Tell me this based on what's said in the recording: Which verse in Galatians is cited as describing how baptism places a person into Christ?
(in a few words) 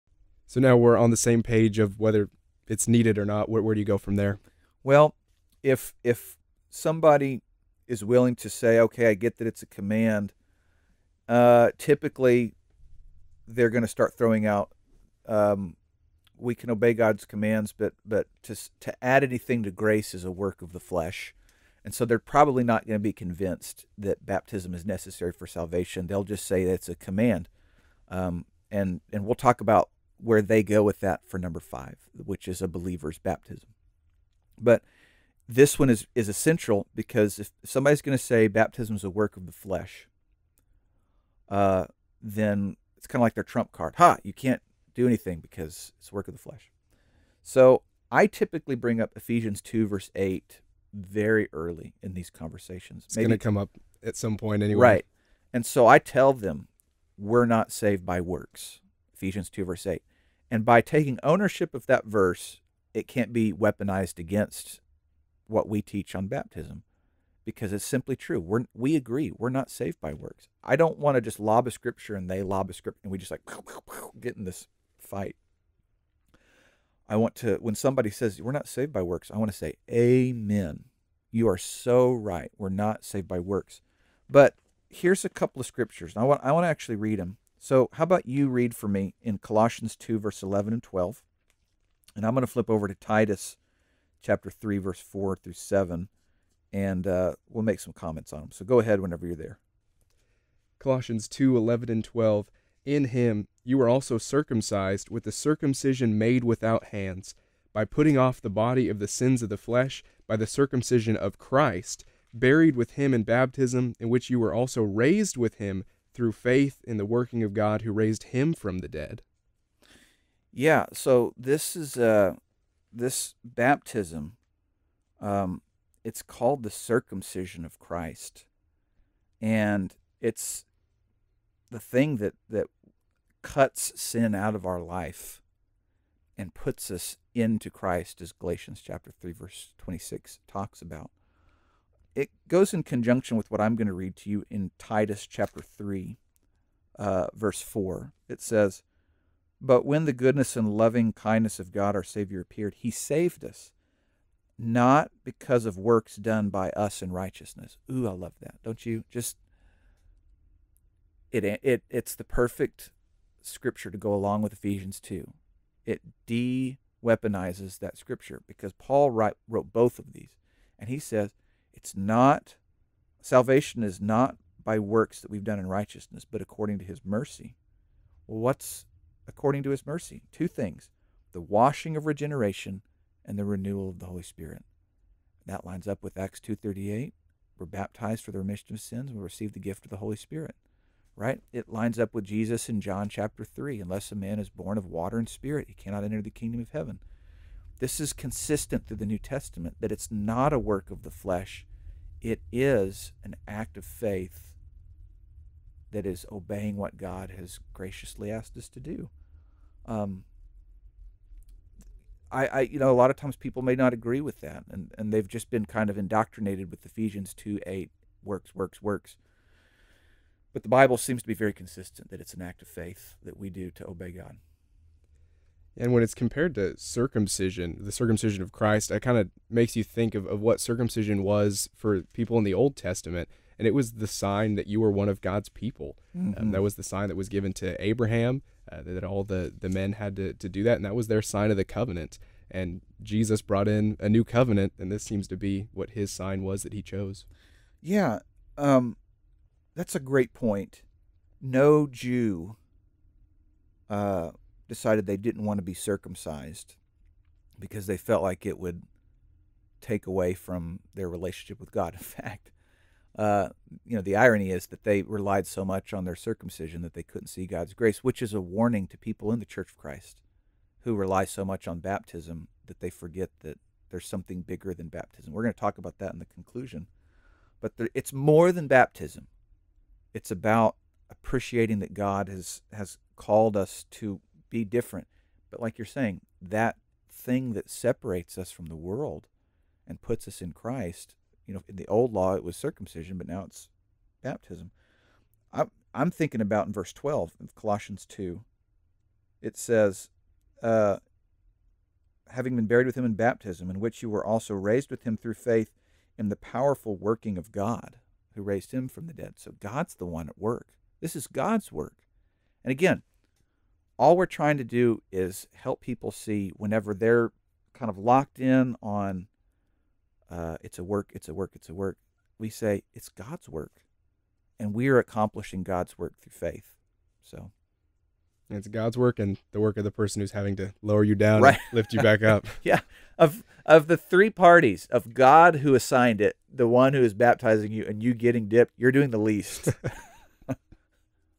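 Galatians 3:26.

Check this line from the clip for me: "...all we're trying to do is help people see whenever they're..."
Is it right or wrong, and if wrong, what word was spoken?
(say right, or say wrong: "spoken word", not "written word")
right.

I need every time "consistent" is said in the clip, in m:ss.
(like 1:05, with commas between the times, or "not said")
3:18, 3:41.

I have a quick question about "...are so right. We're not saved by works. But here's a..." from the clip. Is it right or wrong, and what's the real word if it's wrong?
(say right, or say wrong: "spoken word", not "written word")
right.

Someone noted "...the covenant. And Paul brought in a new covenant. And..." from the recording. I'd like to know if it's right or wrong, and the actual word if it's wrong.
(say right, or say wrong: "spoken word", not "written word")
wrong: "Jesus", not "Paul".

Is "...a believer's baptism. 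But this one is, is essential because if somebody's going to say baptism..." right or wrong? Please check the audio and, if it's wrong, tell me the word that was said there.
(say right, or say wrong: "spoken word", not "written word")
right.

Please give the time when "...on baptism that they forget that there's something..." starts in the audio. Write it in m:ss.
4:31.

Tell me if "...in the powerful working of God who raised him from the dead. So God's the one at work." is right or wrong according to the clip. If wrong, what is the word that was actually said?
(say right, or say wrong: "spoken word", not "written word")
right.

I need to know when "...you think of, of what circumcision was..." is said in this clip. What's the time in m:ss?
3:49.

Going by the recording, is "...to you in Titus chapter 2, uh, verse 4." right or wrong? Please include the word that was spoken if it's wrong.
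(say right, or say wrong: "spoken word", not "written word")
wrong: "3", not "2".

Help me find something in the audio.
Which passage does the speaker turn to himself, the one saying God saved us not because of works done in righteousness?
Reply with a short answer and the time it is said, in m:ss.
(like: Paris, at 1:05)
Titus 3:4-7, at 1:32.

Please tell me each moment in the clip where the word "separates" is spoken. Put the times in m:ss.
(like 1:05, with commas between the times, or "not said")
4:47.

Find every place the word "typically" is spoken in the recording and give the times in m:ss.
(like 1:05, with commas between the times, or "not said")
0:11, 0:48.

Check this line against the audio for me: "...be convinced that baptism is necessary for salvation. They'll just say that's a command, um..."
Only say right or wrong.
right.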